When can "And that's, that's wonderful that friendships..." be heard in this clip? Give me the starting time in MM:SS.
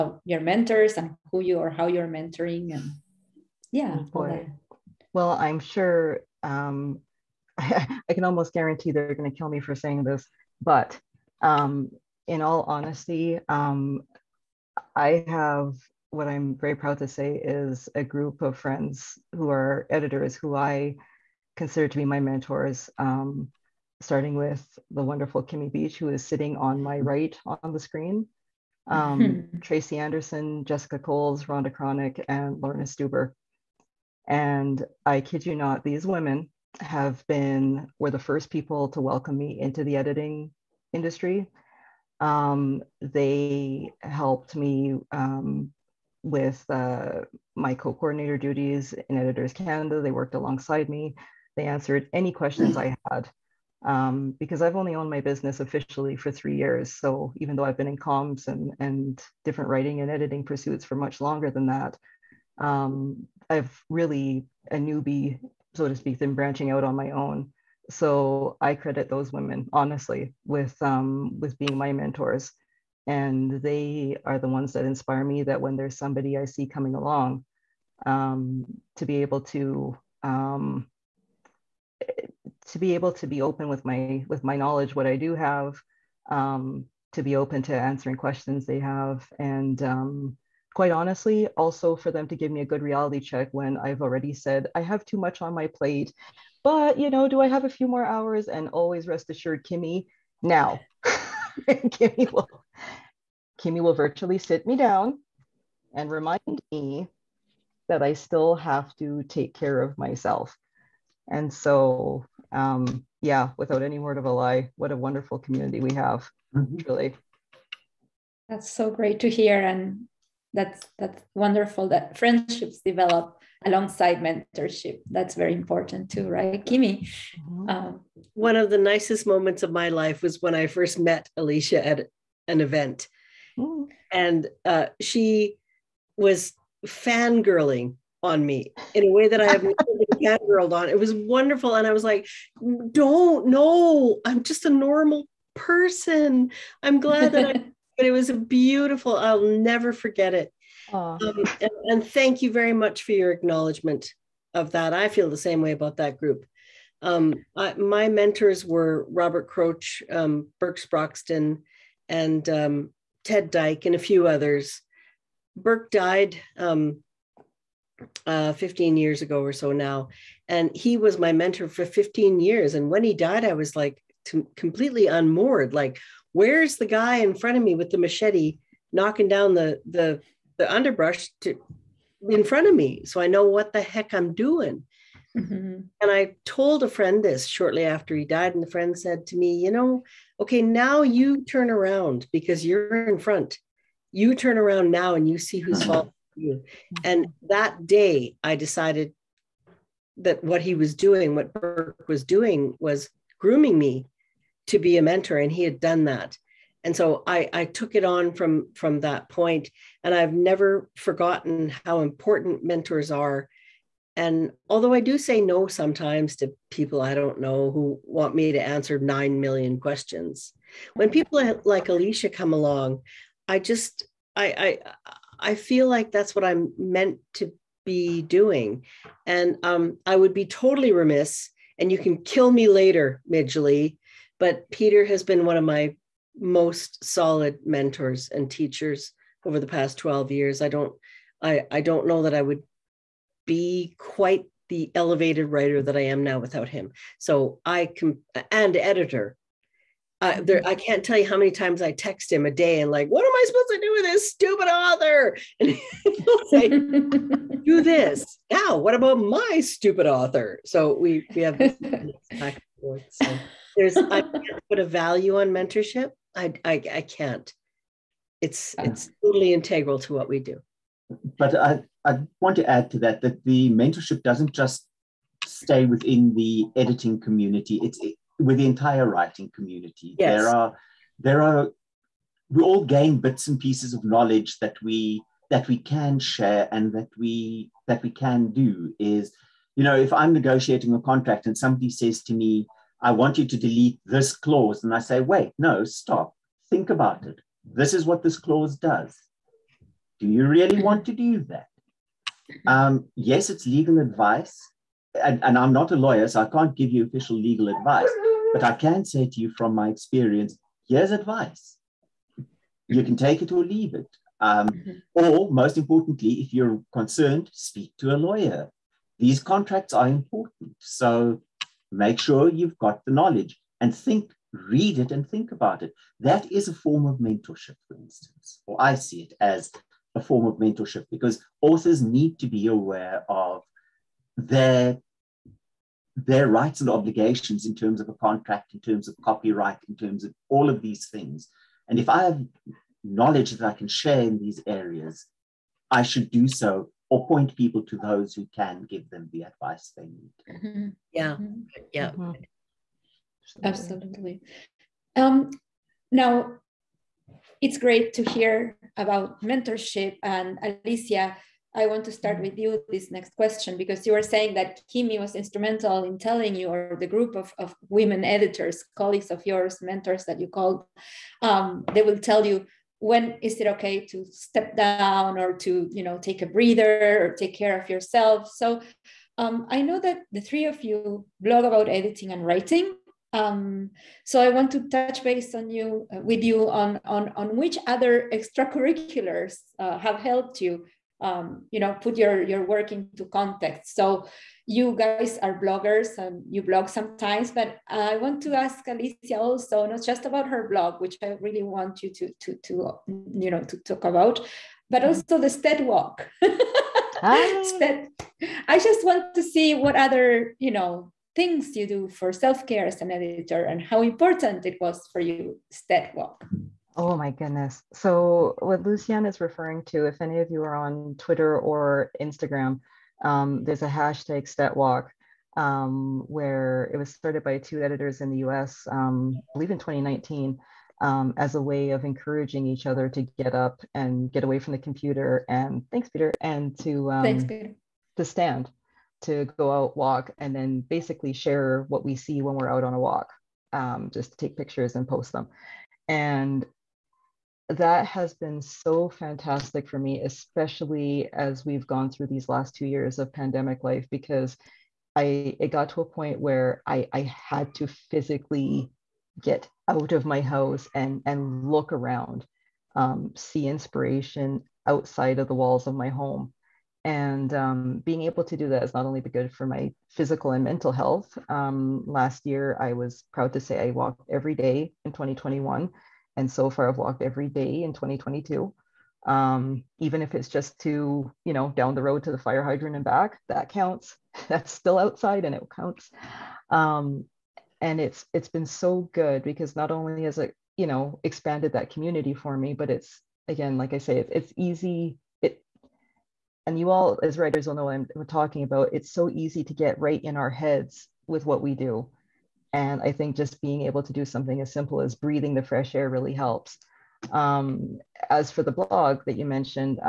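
01:59.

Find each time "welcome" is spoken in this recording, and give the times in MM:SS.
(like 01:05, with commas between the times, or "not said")
00:38.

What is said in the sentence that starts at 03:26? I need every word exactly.
And so I, I took it on from from that point, and I've never forgotten how important mentors are.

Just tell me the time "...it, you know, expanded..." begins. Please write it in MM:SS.
08:10.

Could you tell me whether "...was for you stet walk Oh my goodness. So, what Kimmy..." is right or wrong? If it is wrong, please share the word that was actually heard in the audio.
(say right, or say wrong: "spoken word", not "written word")
wrong: "Luciana", not "Kimmy".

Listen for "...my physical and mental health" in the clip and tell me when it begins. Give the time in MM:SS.
07:49.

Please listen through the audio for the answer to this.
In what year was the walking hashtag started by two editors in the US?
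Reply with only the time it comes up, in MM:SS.
07:09.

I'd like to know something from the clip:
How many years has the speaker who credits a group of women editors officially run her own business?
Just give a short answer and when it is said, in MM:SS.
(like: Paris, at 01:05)
3, at 00:56.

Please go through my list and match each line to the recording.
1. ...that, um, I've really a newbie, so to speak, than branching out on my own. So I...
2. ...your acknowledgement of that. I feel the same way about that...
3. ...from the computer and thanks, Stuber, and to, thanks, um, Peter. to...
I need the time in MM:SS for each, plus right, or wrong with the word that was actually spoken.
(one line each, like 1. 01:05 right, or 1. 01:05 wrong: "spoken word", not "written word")
1. 01:01 right
2. 02:33 right
3. 07:14 wrong: "Peter", not "Stuber".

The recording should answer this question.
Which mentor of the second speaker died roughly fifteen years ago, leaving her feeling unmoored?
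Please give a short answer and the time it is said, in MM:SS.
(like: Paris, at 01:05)
Birk Sproxton, at 02:40.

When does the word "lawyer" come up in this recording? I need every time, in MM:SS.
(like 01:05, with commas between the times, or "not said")
05:05, 05:18.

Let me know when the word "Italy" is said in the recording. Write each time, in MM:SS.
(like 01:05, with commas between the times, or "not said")
not said.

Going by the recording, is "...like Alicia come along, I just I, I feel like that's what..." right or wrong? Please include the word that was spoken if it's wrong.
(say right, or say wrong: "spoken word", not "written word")
right.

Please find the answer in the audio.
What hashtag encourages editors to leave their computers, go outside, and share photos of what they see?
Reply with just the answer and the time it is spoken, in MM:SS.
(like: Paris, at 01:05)
StetWalk, at 07:04.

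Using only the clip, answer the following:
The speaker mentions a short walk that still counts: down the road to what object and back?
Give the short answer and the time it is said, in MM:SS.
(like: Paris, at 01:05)
fire hydrant, at 08:02.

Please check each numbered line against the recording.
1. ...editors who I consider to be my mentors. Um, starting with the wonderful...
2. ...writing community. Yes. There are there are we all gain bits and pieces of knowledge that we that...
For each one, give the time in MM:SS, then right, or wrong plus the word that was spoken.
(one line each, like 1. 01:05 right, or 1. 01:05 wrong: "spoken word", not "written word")
1. 00:19 right
2. 04:39 right.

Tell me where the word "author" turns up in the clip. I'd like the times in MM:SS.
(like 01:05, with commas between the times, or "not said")
04:14, 04:20, 05:31.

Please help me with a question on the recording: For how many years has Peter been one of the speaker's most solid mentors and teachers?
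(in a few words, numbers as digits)
12.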